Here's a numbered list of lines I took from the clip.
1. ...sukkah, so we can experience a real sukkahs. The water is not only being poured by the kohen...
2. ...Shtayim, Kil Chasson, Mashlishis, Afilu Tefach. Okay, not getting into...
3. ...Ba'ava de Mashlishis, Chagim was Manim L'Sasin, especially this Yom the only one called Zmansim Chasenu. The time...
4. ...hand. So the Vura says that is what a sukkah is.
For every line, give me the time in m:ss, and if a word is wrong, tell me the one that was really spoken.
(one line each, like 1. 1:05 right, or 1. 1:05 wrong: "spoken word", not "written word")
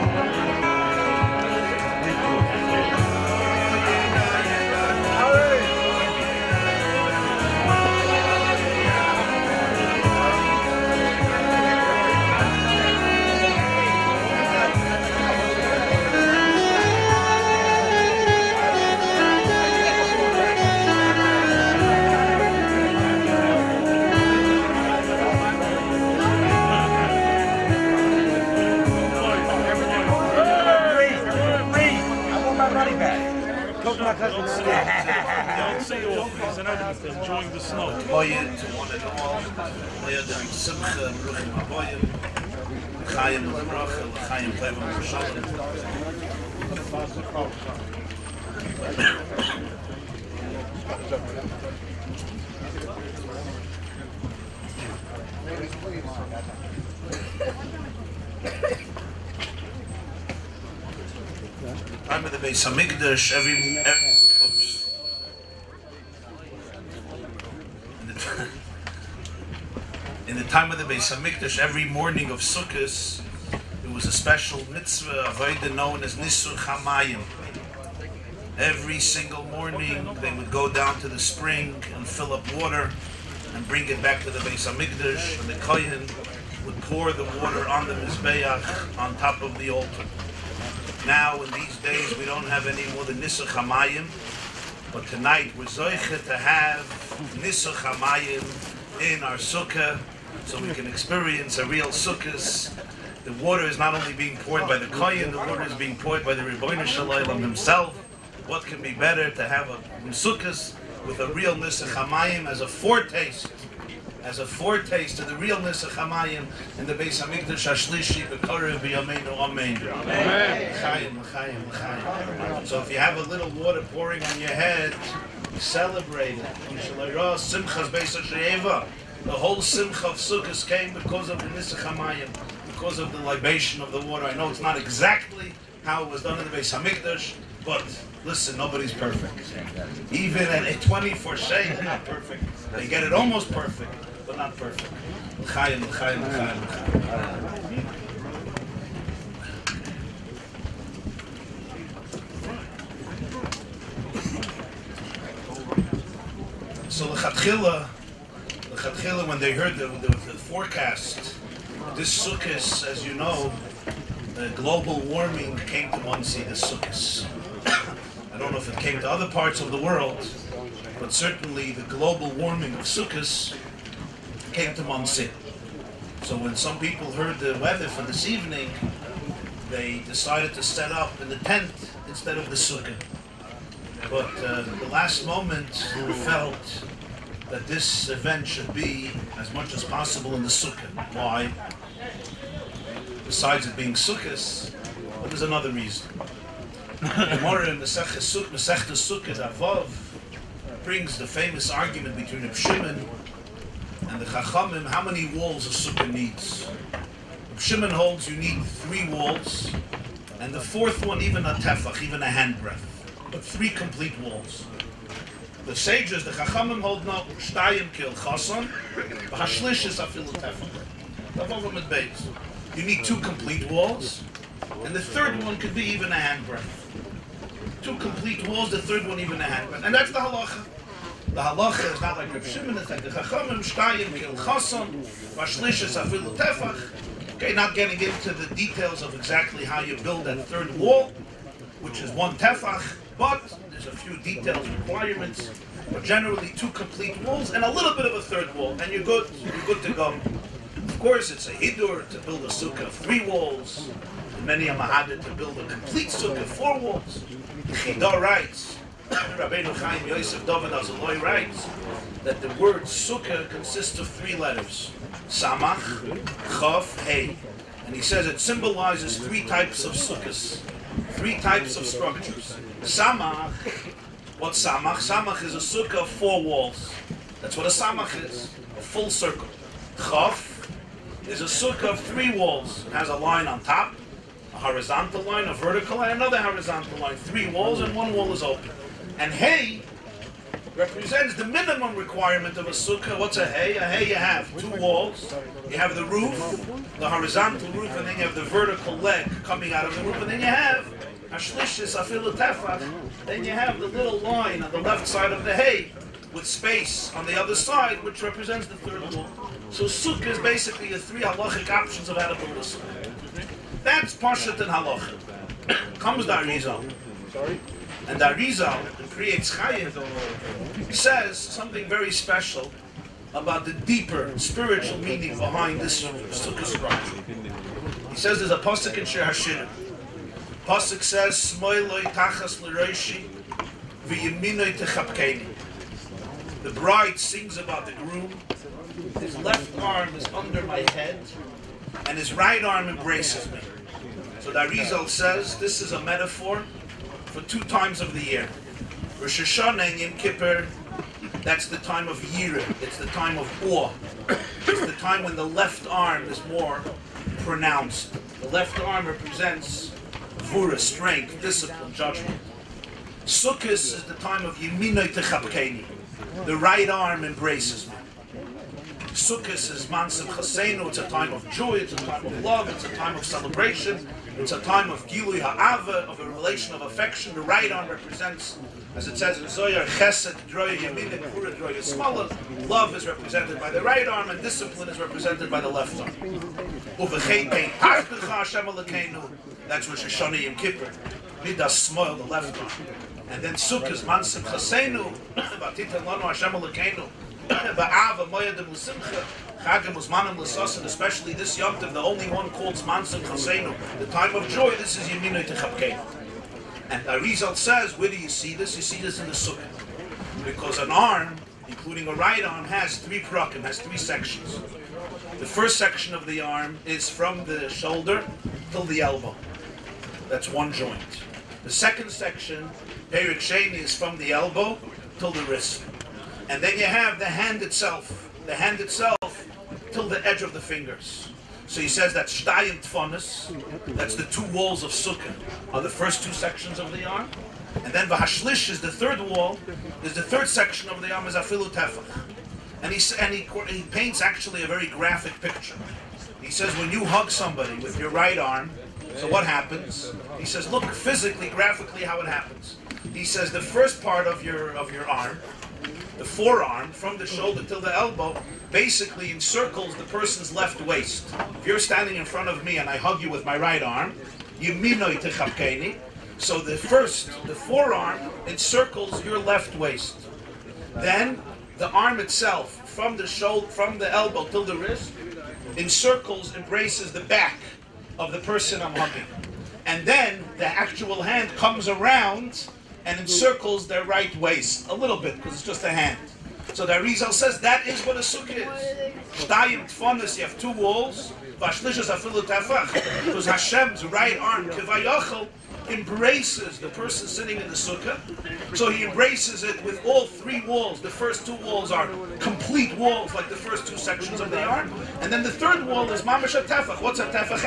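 1. 1:39 right
2. 3:53 right
3. 6:37 wrong: "Usimcha", not "Mashlishis"
4. 8:05 wrong: "Arizal", not "Vura".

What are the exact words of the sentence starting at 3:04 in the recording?
But uh, the last moment felt that this event should be as much as possible in the sukkah.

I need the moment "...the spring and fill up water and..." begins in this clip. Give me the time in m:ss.
1:21.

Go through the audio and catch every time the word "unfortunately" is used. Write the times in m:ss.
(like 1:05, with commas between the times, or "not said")
not said.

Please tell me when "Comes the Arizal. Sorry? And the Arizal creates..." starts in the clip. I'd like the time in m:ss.
5:15.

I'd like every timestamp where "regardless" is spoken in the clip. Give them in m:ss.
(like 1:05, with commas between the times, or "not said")
not said.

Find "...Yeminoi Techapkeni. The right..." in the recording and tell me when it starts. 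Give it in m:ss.
6:04.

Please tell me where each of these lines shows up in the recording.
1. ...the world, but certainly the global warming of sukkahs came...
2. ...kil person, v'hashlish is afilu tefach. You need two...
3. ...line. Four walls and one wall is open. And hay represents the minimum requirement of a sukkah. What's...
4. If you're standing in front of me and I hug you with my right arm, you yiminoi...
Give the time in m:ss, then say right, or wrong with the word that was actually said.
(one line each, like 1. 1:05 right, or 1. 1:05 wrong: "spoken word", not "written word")
1. 2:49 right
2. 3:37 wrong: "chason", not "person"
3. 4:46 wrong: "Three", not "Four"
4. 7:41 right.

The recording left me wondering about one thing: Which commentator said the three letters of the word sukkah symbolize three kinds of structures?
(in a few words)
Chida.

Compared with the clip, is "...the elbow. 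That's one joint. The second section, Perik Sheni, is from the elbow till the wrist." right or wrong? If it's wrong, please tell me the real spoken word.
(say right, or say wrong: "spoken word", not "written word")
right.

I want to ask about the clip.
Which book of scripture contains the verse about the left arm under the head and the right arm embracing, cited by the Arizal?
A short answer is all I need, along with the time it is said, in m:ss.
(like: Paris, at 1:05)
Shir Hashirim, at 5:29.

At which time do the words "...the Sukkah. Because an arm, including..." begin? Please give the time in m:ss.
6:49.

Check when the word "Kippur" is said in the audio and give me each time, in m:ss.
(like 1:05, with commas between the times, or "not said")
5:50, 6:30.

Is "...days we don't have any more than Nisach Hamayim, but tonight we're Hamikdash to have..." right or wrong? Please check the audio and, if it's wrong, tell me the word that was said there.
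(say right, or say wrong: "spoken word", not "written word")
wrong: "Zoicha", not "Hamikdash".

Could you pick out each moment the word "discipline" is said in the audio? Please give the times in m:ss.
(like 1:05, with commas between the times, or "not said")
6:01, 6:24.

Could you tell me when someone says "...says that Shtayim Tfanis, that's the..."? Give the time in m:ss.
7:11.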